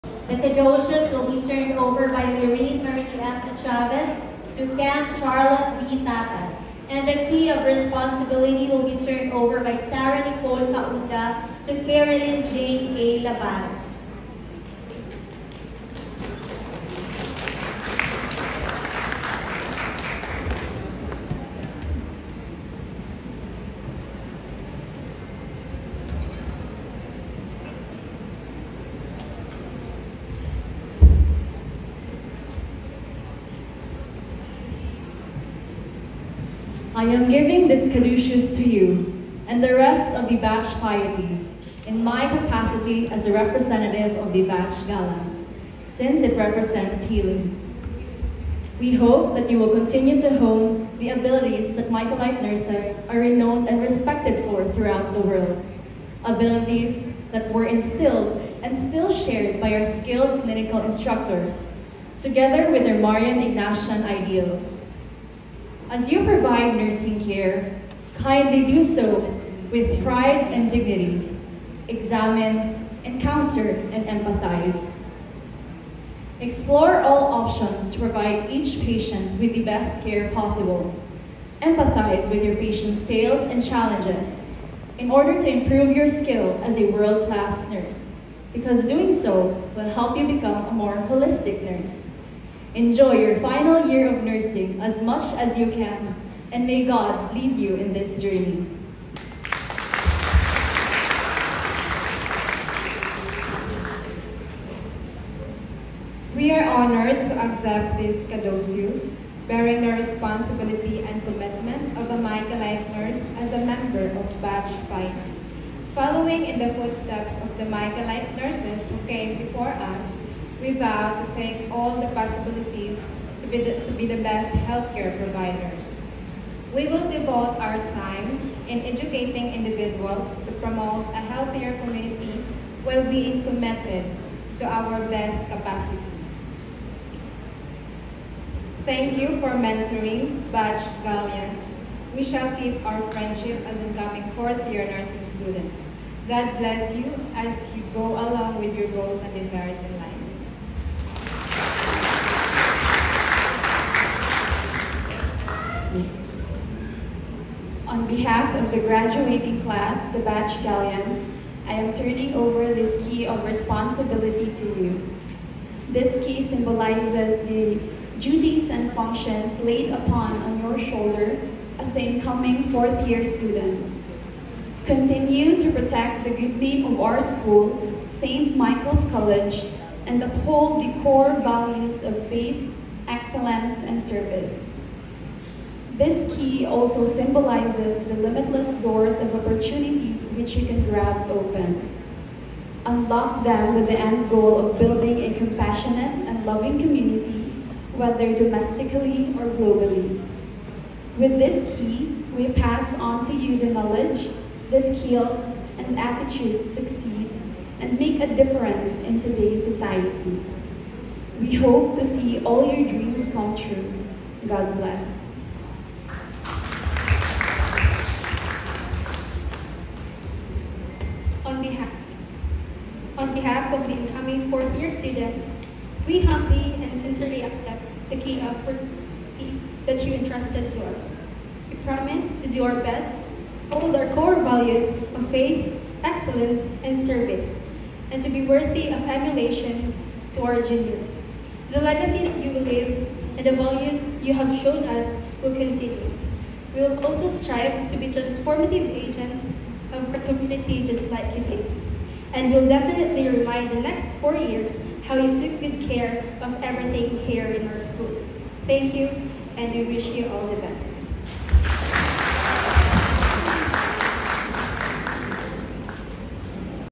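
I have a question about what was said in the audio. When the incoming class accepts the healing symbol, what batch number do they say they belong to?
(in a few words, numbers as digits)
Batch 5.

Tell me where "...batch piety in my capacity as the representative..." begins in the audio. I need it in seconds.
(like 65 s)
40 s.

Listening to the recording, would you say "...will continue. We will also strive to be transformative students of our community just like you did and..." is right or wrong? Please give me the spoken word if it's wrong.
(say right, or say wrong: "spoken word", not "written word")
wrong: "agents", not "students".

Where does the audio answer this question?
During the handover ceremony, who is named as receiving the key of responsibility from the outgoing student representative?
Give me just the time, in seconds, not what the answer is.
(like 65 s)
11 s.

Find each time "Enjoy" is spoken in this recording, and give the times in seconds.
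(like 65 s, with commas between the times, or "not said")
92 s.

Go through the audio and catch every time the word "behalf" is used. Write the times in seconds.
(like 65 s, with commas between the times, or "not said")
158 s, 223 s.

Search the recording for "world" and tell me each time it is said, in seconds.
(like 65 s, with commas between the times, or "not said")
55 s, 86 s.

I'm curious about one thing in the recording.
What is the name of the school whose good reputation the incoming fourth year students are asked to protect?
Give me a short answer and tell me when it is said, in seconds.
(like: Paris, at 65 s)
St. Michael's College, at 178 s.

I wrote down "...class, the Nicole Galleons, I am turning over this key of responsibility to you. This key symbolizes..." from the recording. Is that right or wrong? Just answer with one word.
wrong.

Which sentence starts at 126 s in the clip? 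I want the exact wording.
We will devote our time in educating individuals to promote a healthier community while being committed to our best capacity.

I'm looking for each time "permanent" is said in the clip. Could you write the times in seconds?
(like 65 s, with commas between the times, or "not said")
not said.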